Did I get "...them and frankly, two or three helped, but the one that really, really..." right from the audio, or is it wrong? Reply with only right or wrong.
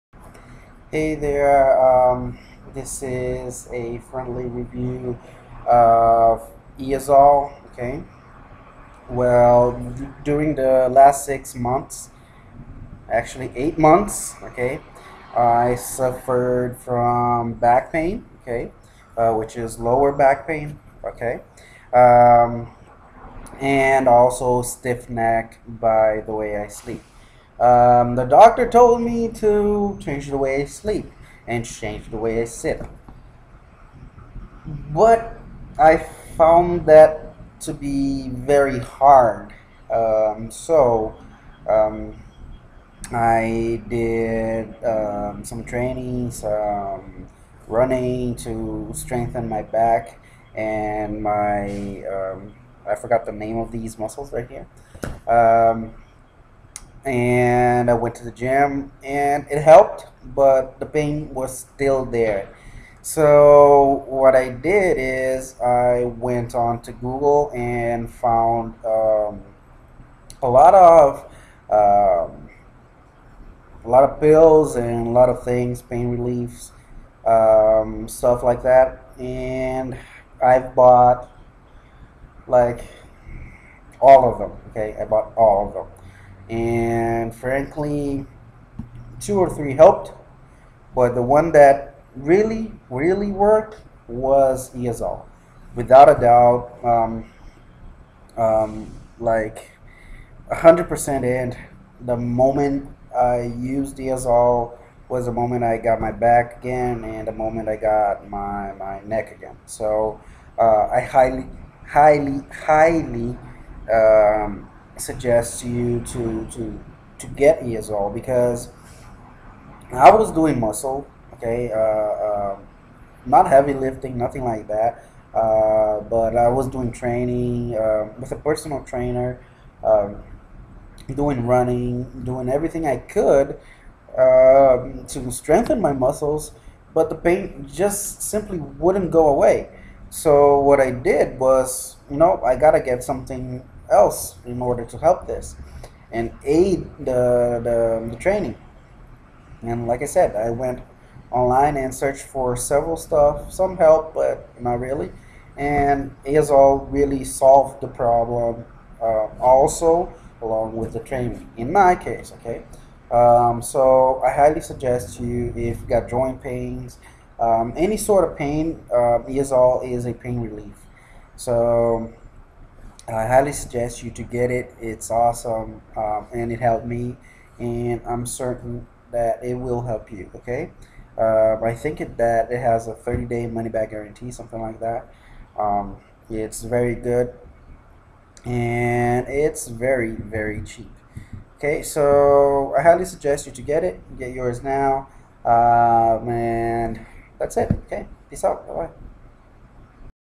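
right.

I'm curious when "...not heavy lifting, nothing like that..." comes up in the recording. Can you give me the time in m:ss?
2:03.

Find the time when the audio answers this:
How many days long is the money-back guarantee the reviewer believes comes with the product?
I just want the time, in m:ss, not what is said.
3:02.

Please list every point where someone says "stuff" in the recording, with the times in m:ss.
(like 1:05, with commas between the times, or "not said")
1:18, 2:32.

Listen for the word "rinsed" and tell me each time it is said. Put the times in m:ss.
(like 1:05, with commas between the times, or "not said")
not said.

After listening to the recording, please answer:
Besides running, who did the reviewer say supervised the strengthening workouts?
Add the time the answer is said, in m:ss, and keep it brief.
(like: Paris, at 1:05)
A personal trainer, at 2:08.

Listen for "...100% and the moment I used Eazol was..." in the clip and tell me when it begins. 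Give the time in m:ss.
1:40.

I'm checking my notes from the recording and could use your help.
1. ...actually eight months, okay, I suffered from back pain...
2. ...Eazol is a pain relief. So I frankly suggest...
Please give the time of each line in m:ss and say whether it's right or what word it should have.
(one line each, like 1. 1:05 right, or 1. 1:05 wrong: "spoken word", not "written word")
1. 0:13 right
2. 2:49 wrong: "highly", not "frankly".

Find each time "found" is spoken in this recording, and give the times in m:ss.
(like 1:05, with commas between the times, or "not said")
0:36, 1:08.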